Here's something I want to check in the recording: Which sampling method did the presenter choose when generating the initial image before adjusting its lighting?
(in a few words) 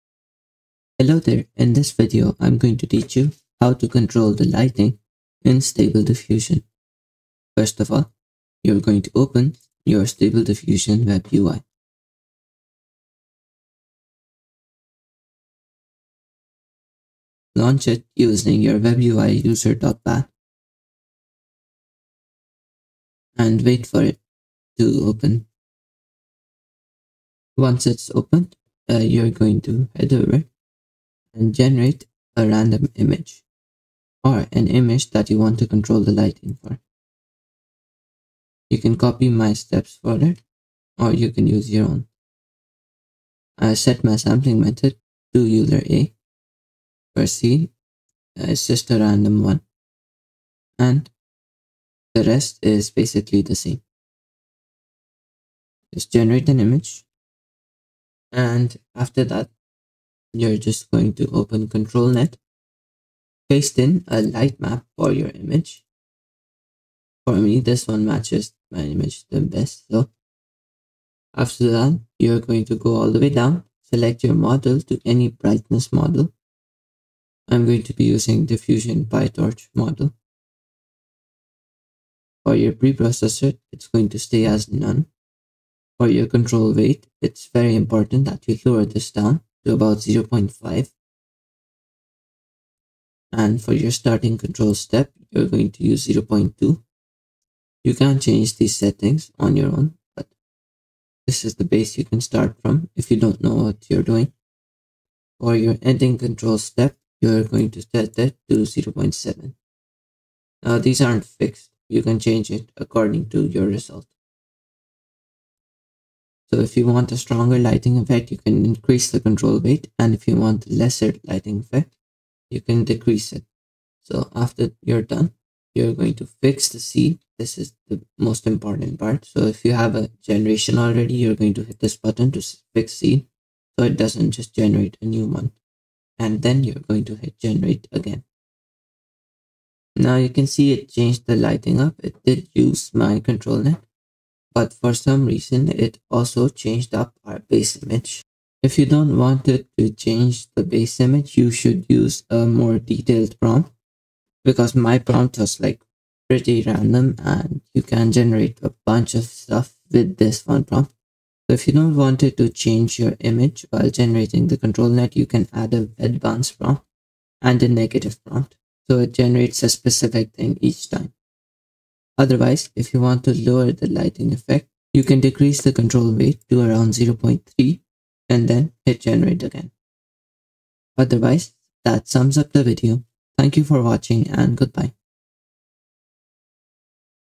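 Euler a.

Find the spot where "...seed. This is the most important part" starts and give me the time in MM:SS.
02:06.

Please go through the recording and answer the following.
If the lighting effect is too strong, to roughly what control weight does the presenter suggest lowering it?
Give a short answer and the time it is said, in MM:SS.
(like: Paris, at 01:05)
0.3, at 02:56.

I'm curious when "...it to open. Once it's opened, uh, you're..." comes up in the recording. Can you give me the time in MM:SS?
00:24.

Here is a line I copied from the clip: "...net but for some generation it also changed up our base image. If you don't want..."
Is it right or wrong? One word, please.
wrong.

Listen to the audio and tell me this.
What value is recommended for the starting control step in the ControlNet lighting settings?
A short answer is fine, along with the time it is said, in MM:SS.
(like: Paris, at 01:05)
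0.2, at 01:36.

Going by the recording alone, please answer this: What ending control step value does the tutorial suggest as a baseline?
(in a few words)
0.7.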